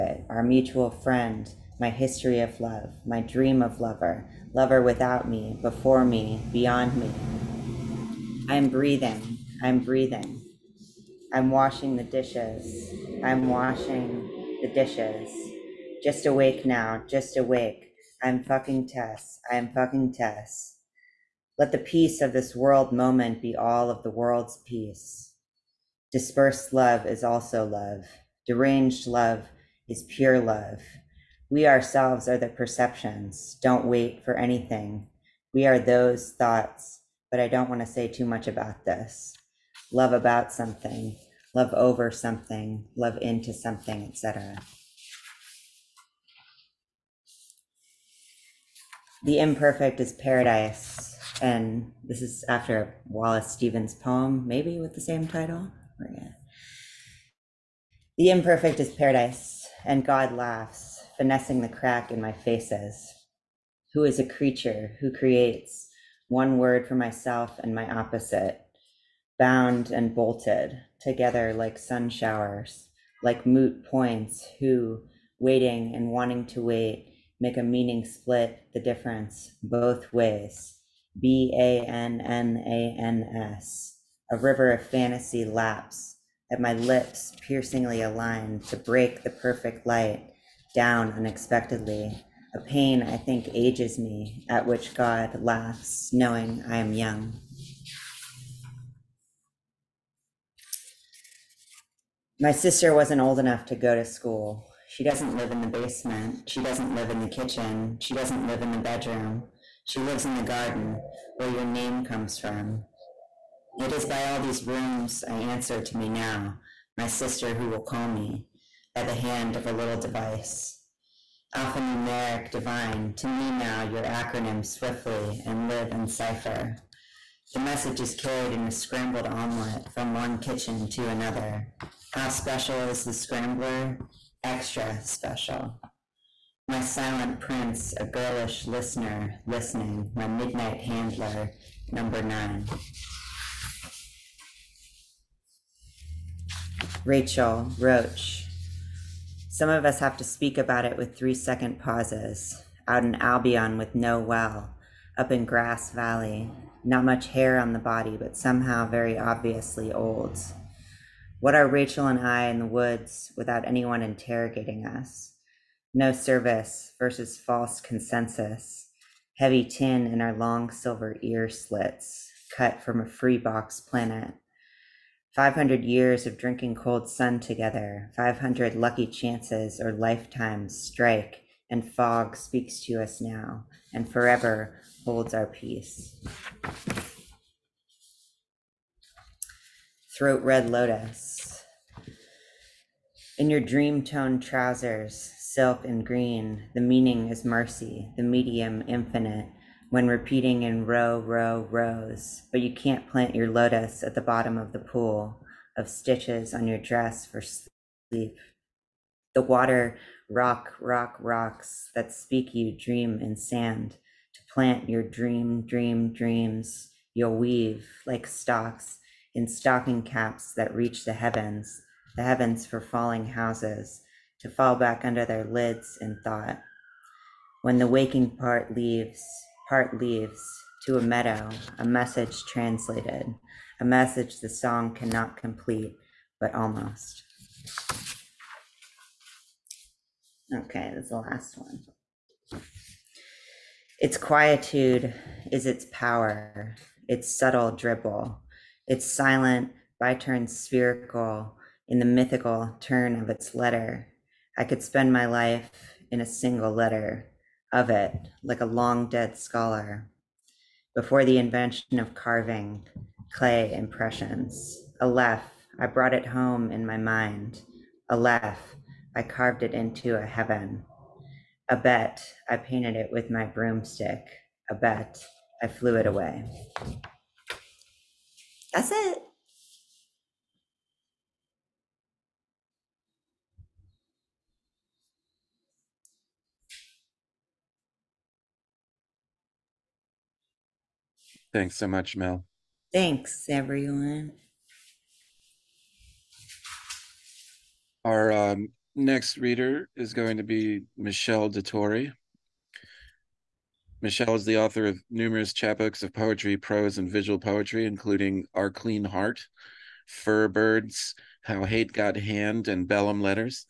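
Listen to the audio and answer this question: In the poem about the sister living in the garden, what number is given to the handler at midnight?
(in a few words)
9.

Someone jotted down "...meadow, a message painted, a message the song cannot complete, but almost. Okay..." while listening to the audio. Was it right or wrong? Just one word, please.
wrong.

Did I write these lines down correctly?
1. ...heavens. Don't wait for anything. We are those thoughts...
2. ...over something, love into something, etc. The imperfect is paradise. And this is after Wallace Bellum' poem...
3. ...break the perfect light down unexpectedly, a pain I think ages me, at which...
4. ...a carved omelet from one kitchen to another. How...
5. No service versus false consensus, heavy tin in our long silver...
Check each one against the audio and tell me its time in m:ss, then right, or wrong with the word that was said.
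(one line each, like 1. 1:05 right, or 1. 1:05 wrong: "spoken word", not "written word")
1. 0:32 wrong: "perceptions", not "heavens"
2. 0:41 wrong: "Stevens", not "Bellum"
3. 1:28 right
4. 2:08 wrong: "scrambled", not "carved"
5. 2:45 right.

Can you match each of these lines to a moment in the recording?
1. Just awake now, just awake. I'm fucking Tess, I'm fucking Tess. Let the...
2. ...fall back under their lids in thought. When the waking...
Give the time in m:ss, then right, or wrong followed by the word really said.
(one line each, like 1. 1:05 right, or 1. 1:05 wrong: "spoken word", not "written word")
1. 0:16 right
2. 3:44 right.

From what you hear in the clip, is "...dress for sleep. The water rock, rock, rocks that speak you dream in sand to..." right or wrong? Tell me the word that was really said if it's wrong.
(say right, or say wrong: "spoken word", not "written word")
right.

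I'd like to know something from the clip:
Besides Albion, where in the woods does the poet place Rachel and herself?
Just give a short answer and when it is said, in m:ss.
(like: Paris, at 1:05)
Grass Valley, at 2:35.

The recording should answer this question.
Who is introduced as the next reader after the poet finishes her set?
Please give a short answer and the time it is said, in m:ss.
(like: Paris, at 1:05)
Michelle Detorie, at 5:00.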